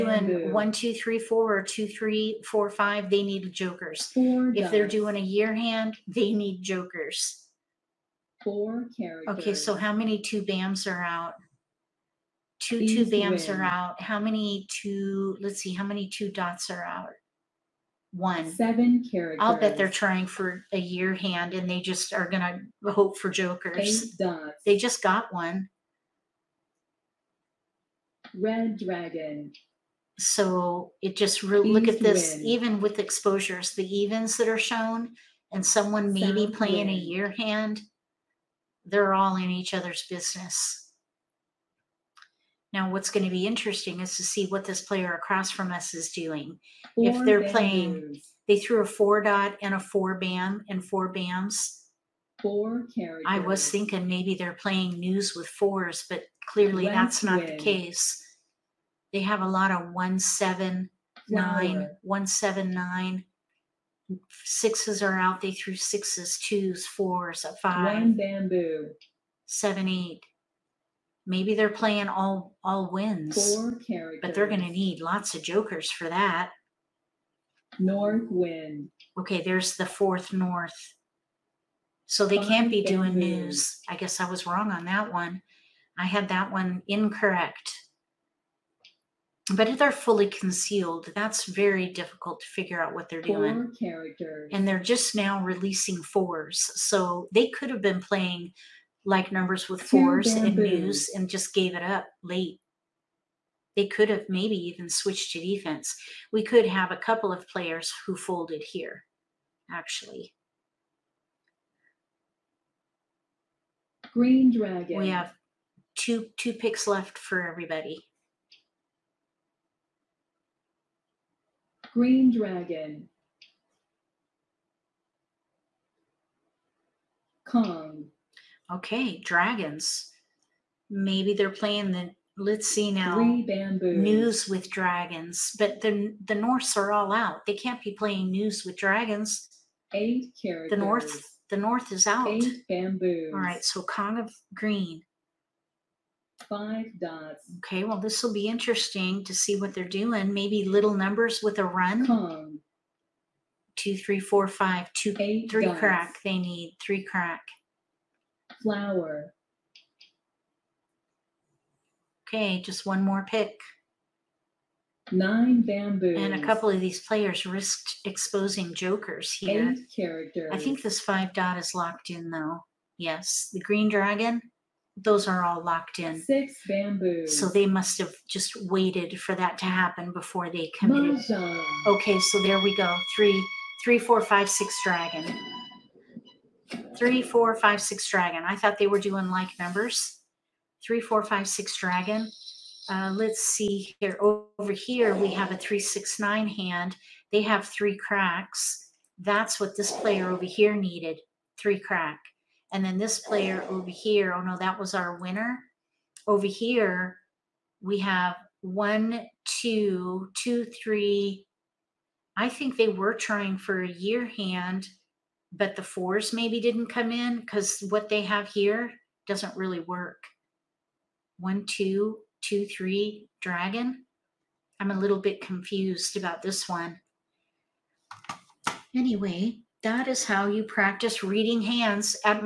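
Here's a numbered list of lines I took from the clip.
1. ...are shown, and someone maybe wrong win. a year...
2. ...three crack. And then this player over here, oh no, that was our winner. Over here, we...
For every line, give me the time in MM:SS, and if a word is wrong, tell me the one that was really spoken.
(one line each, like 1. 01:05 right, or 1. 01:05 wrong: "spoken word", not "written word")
1. 00:34 wrong: "playing", not "wrong"
2. 03:21 right.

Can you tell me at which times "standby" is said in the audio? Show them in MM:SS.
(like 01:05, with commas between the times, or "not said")
not said.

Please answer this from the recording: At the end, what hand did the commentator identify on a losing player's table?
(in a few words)
three, six, nine hand.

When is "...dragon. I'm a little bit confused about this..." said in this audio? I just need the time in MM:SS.
03:43.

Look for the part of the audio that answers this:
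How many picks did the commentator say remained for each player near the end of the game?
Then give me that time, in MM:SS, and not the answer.
01:55.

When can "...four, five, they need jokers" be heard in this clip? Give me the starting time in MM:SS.
00:02.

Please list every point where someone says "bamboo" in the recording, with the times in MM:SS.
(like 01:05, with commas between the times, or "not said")
01:08, 02:13, 02:22, 02:45, 02:56.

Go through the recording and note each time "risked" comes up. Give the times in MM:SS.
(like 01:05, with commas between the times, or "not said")
02:47.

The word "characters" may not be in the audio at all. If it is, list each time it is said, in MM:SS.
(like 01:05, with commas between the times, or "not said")
00:08, 00:19, 00:52, 01:13, 01:33, 02:20, 02:49.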